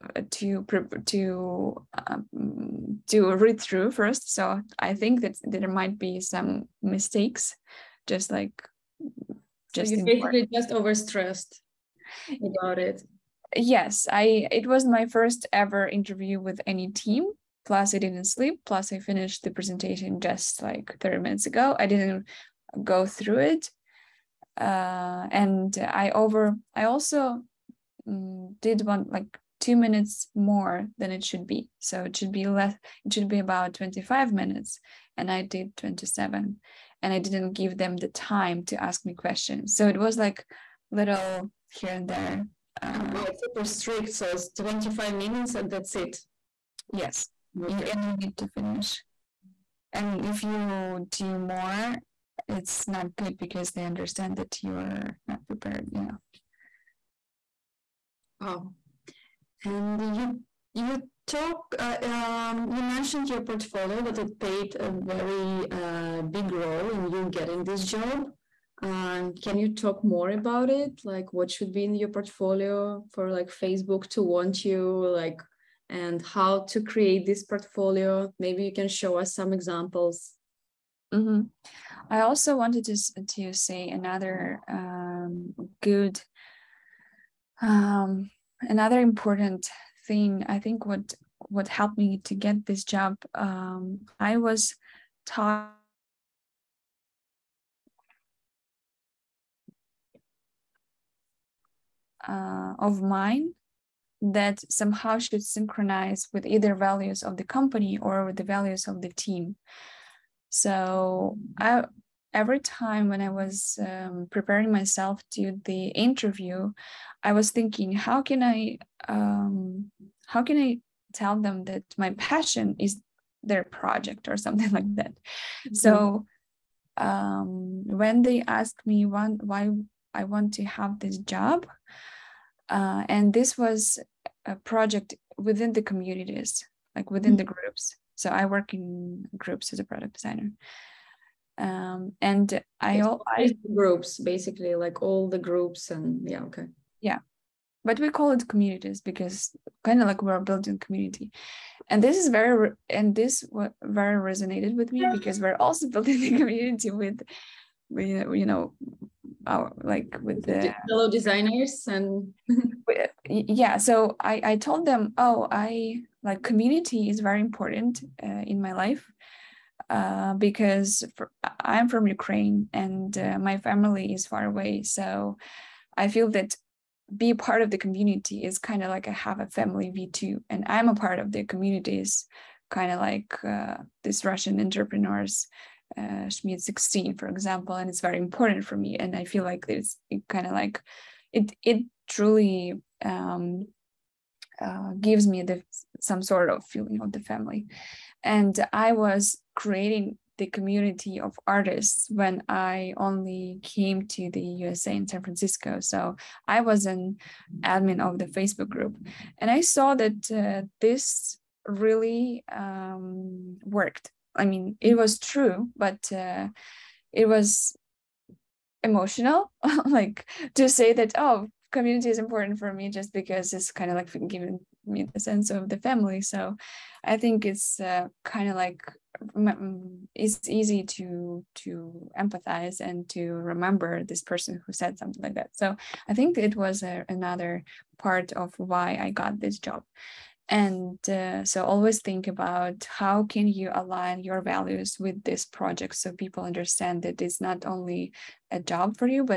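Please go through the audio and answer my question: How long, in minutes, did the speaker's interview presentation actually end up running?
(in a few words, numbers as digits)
27 minutes.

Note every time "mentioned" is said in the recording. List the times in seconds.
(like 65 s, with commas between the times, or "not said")
62 s.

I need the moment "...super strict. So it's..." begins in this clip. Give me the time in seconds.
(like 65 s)
43 s.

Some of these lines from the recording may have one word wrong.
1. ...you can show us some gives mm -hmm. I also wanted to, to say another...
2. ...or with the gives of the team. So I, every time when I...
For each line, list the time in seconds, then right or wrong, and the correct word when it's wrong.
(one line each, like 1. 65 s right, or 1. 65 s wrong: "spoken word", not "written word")
1. 78 s wrong: "examples", not "gives"
2. 108 s wrong: "values", not "gives".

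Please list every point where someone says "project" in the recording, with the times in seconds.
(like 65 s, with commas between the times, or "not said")
123 s, 134 s, 245 s.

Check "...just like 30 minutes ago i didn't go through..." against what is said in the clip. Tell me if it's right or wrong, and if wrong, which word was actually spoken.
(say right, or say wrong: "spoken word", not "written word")
right.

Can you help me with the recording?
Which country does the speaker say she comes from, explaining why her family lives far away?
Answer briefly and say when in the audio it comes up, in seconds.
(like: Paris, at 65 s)
Ukraine, at 172 s.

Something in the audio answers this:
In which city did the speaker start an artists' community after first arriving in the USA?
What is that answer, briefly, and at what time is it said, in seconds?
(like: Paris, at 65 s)
San Francisco, at 205 s.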